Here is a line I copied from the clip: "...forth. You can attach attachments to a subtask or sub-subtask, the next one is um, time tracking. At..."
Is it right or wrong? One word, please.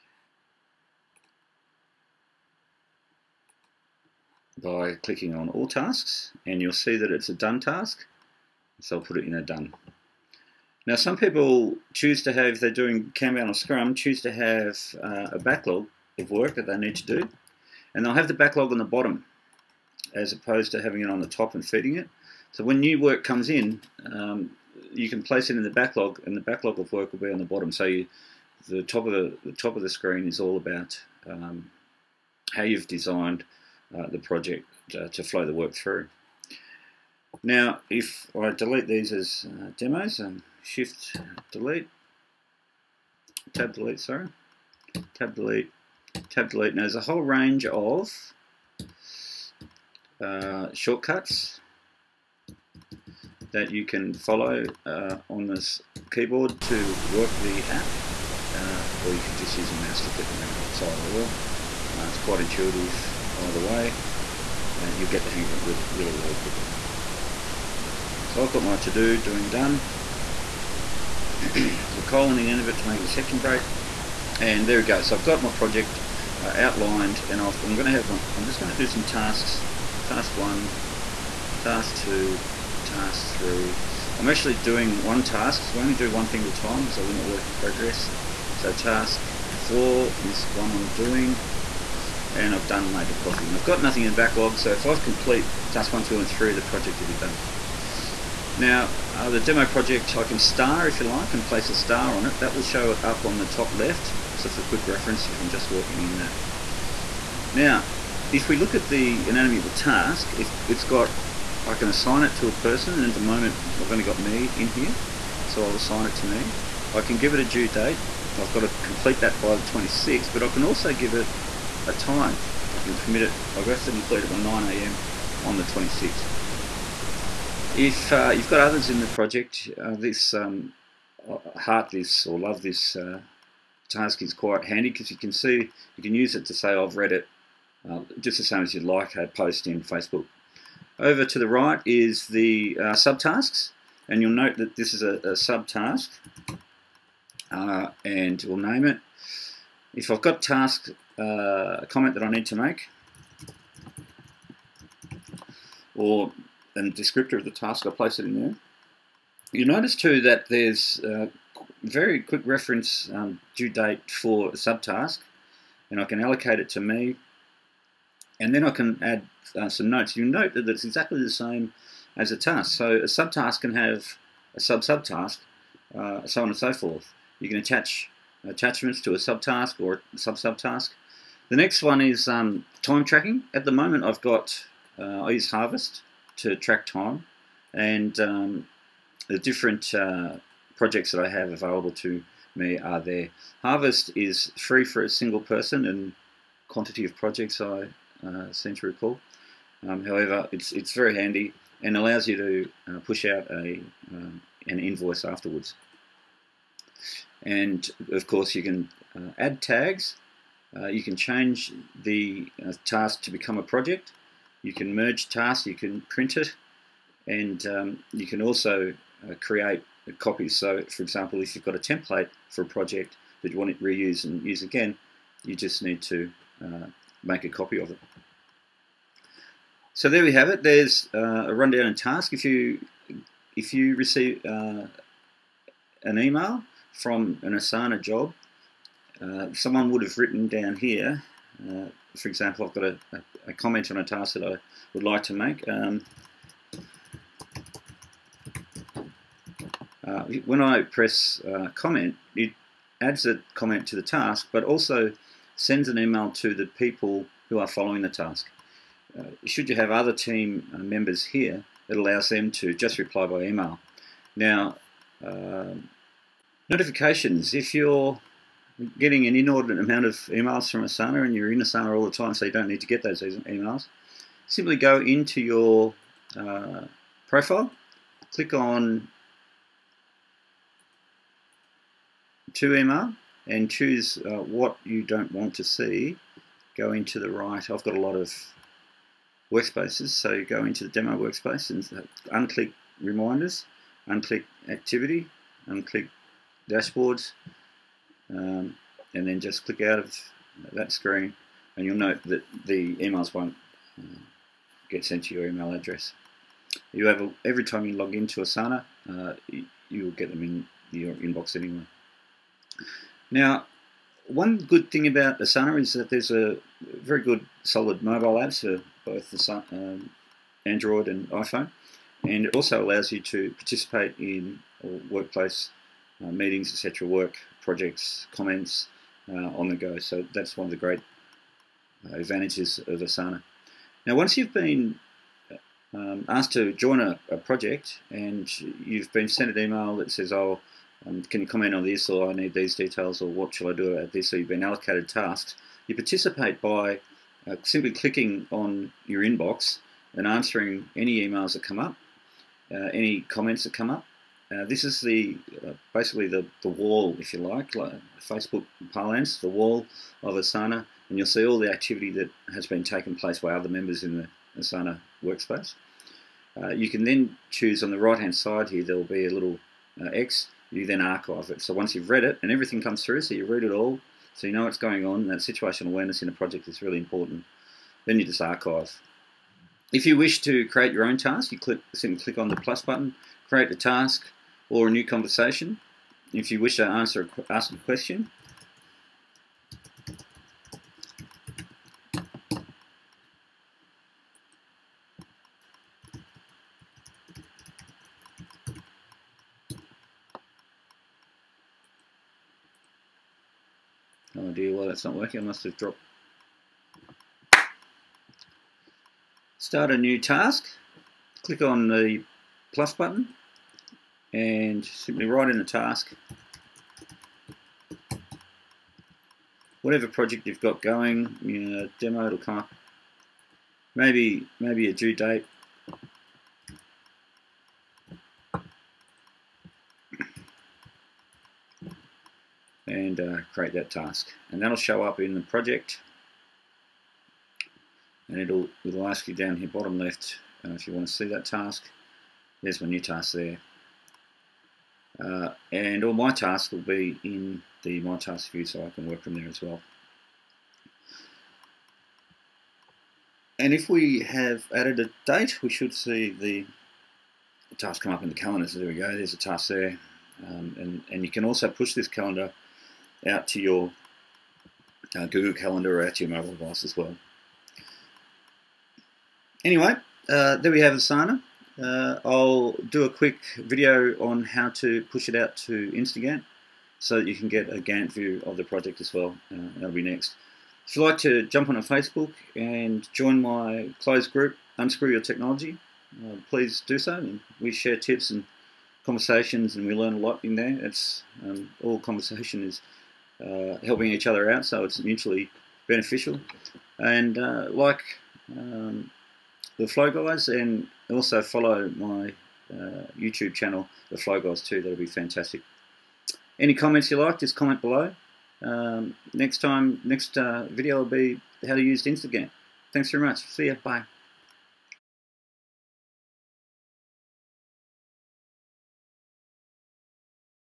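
right.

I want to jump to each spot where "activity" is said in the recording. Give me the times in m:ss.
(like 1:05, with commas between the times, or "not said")
4:54, 6:01.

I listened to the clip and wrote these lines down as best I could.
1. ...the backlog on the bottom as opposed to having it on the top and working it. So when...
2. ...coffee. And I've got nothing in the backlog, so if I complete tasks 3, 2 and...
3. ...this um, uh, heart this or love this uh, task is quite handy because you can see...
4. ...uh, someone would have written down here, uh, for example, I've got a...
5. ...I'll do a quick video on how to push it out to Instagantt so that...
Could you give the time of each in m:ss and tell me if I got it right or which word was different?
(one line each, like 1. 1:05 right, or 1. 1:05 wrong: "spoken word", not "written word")
1. 0:18 wrong: "feeding", not "working"
2. 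1:33 wrong: "1", not "3"
3. 2:09 right
4. 3:59 right
5. 7:52 right.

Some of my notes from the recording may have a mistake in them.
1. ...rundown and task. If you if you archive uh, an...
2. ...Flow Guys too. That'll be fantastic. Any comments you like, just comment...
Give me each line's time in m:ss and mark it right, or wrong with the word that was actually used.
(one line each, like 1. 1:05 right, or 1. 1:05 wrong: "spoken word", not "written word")
1. 3:51 wrong: "receive", not "archive"
2. 8:24 right.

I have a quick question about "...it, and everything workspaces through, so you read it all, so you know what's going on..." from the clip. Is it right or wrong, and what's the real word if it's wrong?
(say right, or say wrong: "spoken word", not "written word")
wrong: "comes", not "workspaces".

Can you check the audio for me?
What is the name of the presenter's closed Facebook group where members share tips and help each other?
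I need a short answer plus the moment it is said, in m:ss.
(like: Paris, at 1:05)
Unscrew Your Technology, at 8:04.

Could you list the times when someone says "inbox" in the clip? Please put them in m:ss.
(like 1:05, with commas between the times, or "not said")
5:11, 5:49.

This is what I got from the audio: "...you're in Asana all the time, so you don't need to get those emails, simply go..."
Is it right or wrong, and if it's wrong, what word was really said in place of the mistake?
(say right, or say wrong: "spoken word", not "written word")
right.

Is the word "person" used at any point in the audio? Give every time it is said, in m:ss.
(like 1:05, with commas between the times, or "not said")
1:52, 3:15.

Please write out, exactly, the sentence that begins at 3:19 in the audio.
Um, however, it's it's very handy and allows you to uh, push out a um, an invoice afterwards.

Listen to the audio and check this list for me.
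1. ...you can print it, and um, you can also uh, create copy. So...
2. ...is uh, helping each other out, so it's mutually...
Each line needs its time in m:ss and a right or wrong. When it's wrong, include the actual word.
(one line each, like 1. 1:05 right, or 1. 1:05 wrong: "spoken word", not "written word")
1. 3:35 right
2. 8:12 right.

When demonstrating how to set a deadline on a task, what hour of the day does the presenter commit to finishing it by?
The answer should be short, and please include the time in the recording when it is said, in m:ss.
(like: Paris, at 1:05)
9am, at 2:04.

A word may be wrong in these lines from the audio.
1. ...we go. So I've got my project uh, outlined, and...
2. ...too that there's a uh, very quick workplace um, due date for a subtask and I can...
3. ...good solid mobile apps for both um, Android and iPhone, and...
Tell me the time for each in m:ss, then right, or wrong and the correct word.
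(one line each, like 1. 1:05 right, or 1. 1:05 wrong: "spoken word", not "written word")
1. 1:14 right
2. 2:39 wrong: "reference", not "workplace"
3. 5:17 right.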